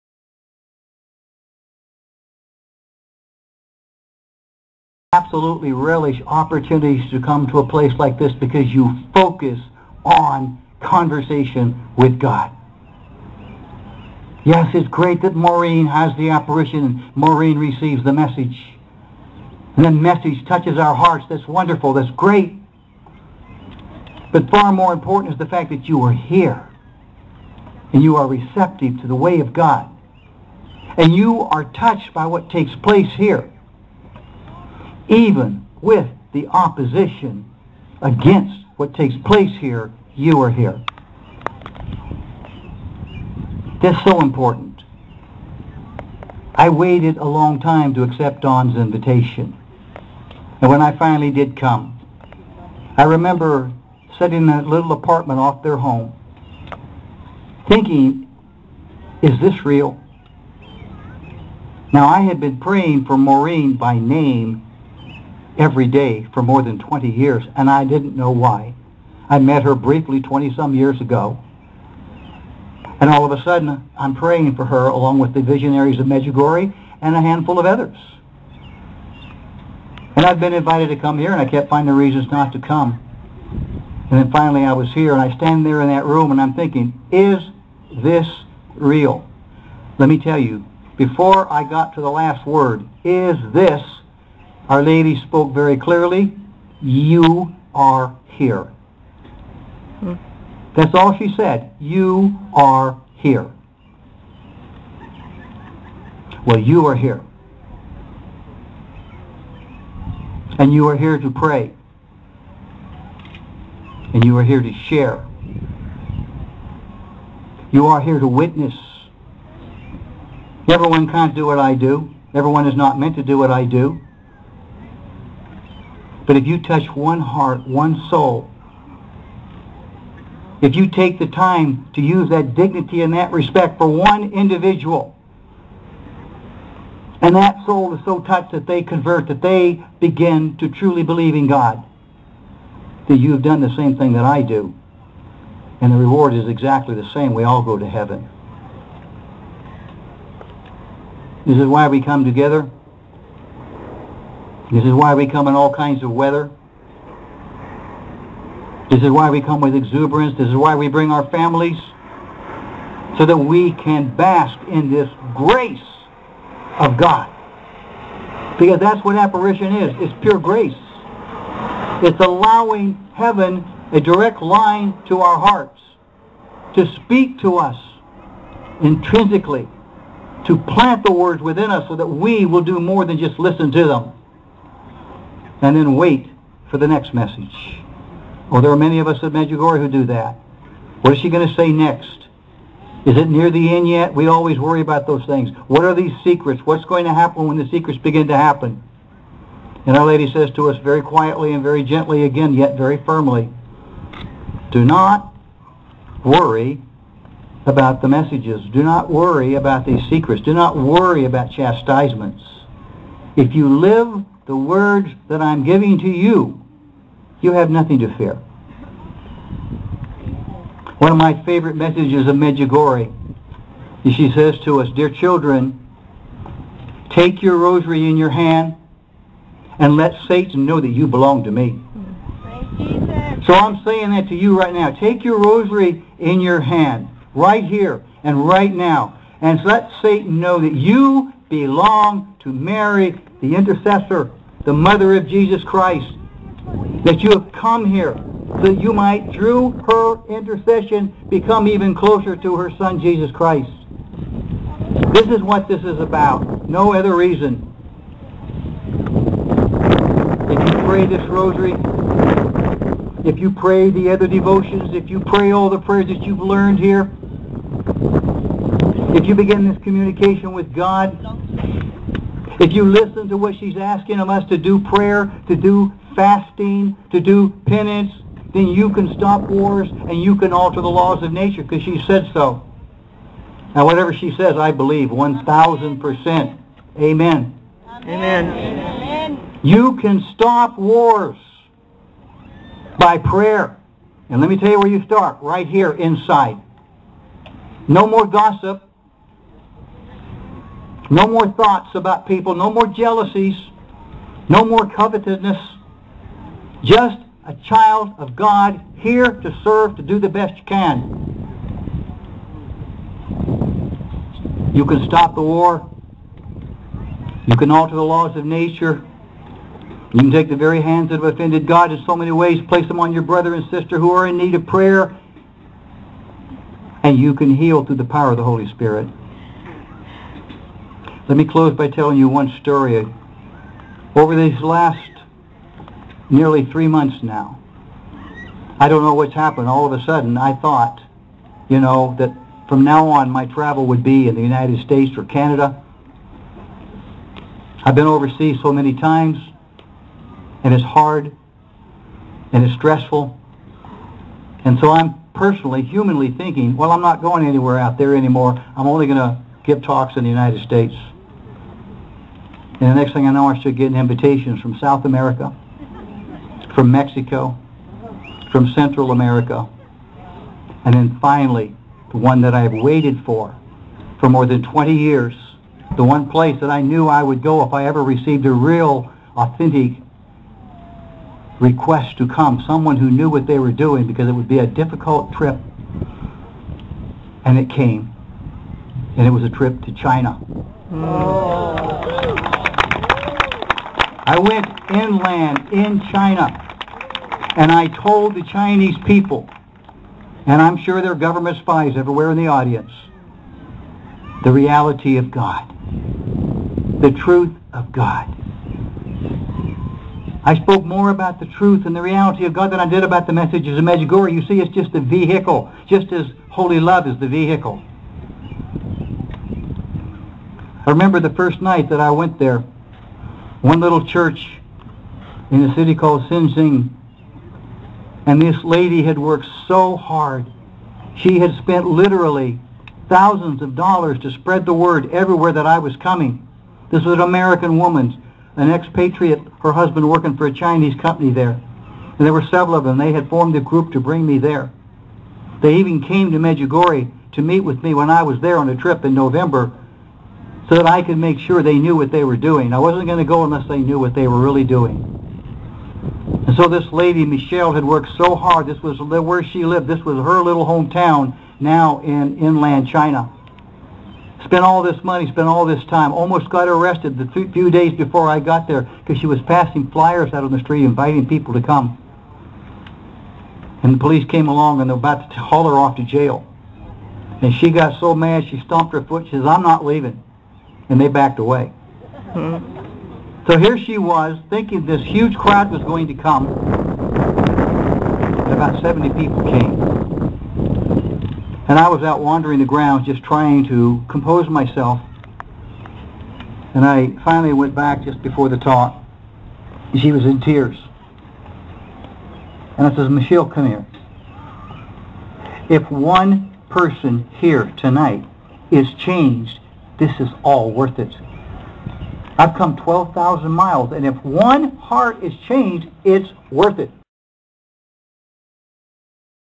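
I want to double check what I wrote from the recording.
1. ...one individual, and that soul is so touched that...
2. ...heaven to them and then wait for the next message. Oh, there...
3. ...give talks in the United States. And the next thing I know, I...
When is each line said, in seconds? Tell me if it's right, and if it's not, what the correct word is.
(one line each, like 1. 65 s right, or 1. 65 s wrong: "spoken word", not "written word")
1. 133 s right
2. 183 s wrong: "listen", not "heaven"
3. 359 s right.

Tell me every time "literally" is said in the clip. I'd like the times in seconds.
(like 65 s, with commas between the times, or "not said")
431 s.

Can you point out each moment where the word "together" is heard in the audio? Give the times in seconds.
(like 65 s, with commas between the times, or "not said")
152 s.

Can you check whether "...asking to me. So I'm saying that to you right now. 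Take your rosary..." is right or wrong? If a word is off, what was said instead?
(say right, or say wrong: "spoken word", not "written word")
wrong: "belong", not "asking".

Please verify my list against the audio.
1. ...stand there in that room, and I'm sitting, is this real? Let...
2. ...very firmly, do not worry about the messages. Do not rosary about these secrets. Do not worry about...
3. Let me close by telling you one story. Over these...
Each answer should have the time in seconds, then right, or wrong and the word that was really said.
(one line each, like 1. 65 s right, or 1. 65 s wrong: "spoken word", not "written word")
1. 85 s wrong: "thinking", not "sitting"
2. 202 s wrong: "worry", not "rosary"
3. 331 s right.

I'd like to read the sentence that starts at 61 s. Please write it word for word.
Now, I had been praying for Maureen by name every day for more than 20 years, and I didn't know why.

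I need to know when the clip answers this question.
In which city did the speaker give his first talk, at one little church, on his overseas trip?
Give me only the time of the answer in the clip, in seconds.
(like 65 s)
426 s.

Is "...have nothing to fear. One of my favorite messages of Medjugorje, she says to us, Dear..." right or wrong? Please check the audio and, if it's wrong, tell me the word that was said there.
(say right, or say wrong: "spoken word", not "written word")
right.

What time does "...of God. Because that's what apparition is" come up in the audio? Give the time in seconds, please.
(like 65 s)
166 s.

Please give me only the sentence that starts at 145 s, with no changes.
And the reward is exactly the same.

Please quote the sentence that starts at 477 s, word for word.
And she got so mad she stomped her foot.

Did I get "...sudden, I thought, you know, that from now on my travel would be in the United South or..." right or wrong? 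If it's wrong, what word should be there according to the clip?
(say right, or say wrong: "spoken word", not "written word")
wrong: "States", not "South".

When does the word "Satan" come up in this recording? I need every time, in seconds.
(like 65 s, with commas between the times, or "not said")
230 s, 240 s.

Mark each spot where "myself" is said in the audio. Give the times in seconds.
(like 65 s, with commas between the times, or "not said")
494 s.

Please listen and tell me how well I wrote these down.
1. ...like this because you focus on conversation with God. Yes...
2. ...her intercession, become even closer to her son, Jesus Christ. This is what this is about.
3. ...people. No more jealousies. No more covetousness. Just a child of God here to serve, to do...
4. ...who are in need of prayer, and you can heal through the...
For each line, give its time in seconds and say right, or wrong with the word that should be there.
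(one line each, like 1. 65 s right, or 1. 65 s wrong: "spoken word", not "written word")
1. 7 s right
2. 249 s right
3. 302 s right
4. 323 s right.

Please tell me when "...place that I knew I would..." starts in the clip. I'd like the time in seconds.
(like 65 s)
376 s.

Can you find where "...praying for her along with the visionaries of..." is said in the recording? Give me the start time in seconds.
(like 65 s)
74 s.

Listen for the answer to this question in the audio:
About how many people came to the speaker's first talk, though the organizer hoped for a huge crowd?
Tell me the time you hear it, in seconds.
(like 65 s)
488 s.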